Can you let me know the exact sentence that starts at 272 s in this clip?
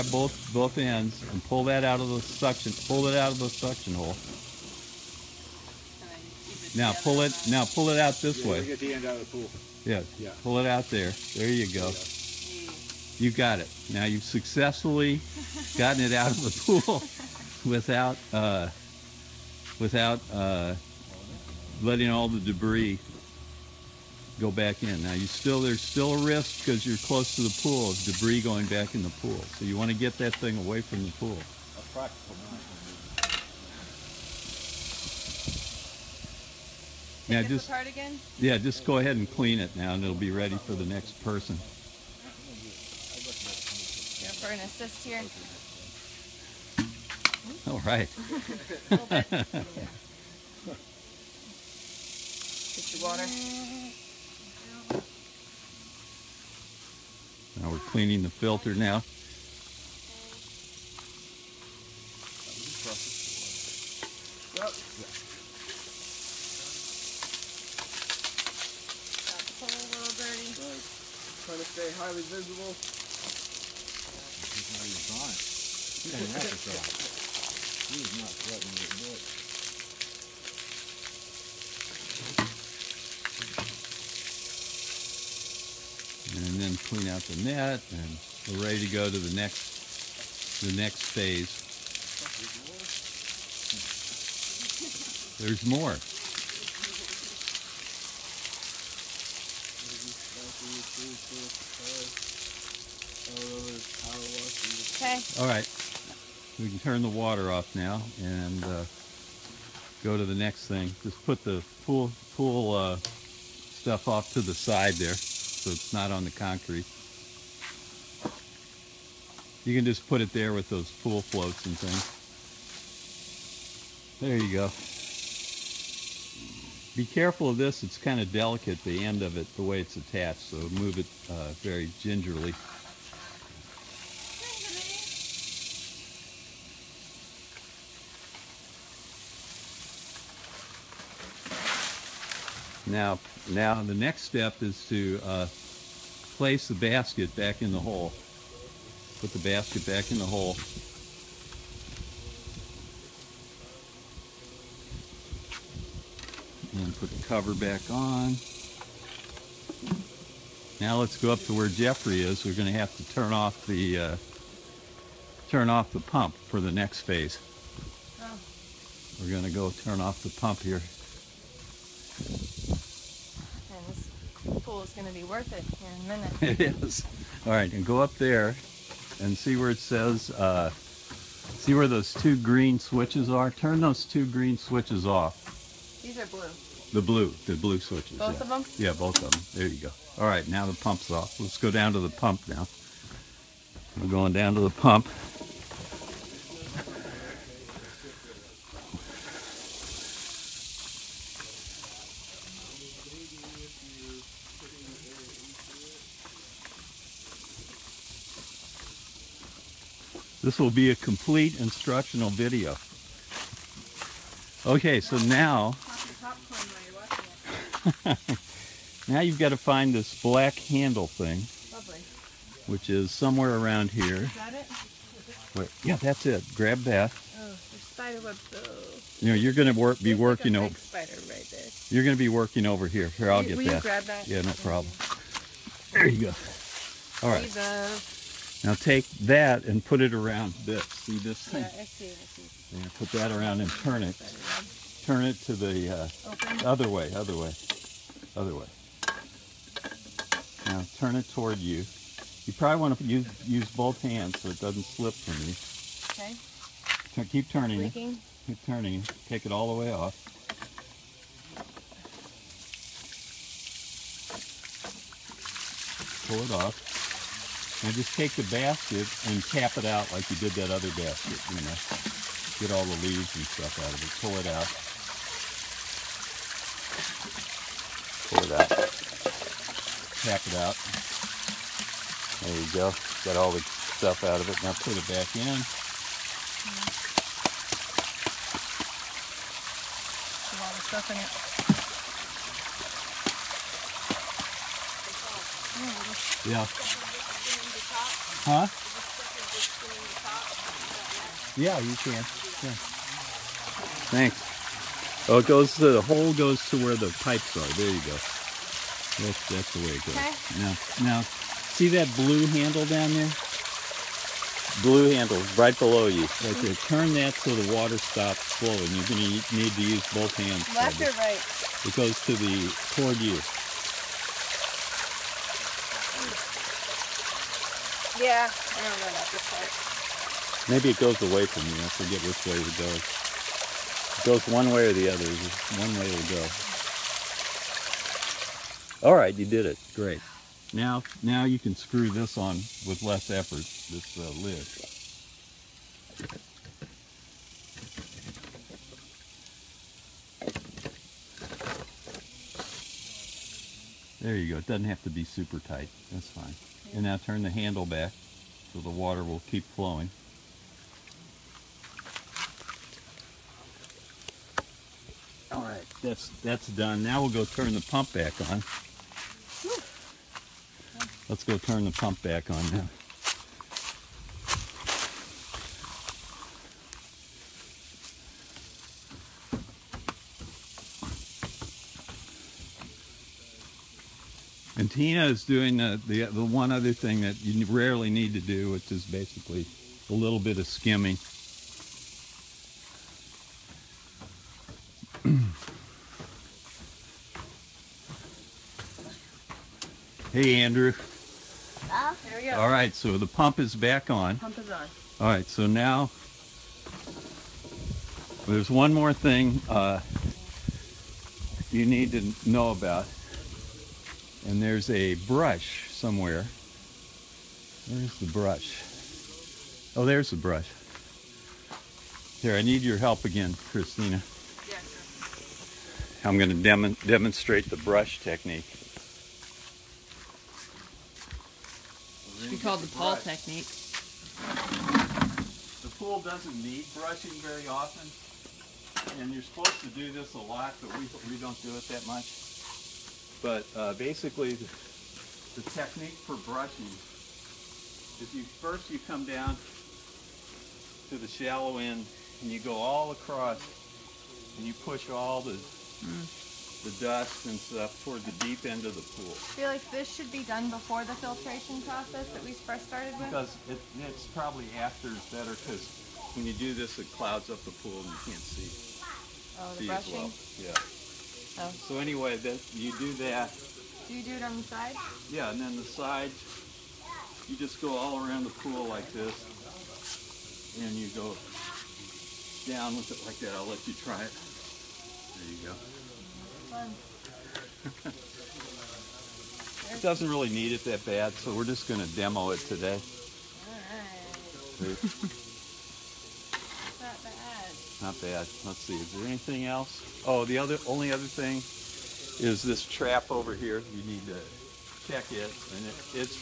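Get all the leaves and stuff out of it.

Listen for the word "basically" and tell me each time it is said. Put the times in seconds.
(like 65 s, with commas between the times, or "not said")
389 s, 443 s.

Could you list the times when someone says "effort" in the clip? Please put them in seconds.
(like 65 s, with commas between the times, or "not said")
343 s.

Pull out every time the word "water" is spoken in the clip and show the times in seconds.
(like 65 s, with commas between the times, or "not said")
53 s, 107 s, 317 s, 358 s.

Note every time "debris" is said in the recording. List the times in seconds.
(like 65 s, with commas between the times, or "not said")
22 s, 28 s.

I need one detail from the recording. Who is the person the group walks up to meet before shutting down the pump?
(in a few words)
Jeffrey.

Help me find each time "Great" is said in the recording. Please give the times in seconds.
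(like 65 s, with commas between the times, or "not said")
339 s.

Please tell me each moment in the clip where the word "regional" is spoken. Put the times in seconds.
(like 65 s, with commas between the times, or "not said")
not said.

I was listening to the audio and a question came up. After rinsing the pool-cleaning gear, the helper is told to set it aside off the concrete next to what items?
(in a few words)
pool floats.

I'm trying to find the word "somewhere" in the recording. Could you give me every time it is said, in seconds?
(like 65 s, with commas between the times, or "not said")
223 s, 415 s.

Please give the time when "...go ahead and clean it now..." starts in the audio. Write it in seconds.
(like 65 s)
38 s.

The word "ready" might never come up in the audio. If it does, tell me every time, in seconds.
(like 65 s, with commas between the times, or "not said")
40 s, 88 s.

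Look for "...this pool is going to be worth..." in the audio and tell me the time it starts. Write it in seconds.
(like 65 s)
173 s.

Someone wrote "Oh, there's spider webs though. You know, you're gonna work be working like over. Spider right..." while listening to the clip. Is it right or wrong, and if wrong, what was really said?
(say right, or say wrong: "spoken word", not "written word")
right.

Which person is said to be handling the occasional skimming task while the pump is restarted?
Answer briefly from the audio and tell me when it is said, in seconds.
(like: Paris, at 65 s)
Tina, at 384 s.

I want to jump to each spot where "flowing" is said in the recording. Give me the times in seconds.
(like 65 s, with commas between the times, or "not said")
318 s, 359 s.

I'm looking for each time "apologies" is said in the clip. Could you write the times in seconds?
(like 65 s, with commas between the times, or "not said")
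not said.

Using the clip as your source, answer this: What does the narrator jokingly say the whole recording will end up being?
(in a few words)
a complete instructional video.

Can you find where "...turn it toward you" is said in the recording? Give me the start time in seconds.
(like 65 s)
250 s.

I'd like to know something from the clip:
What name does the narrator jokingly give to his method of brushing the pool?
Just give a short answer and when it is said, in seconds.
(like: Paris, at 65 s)
the Paul technique, at 432 s.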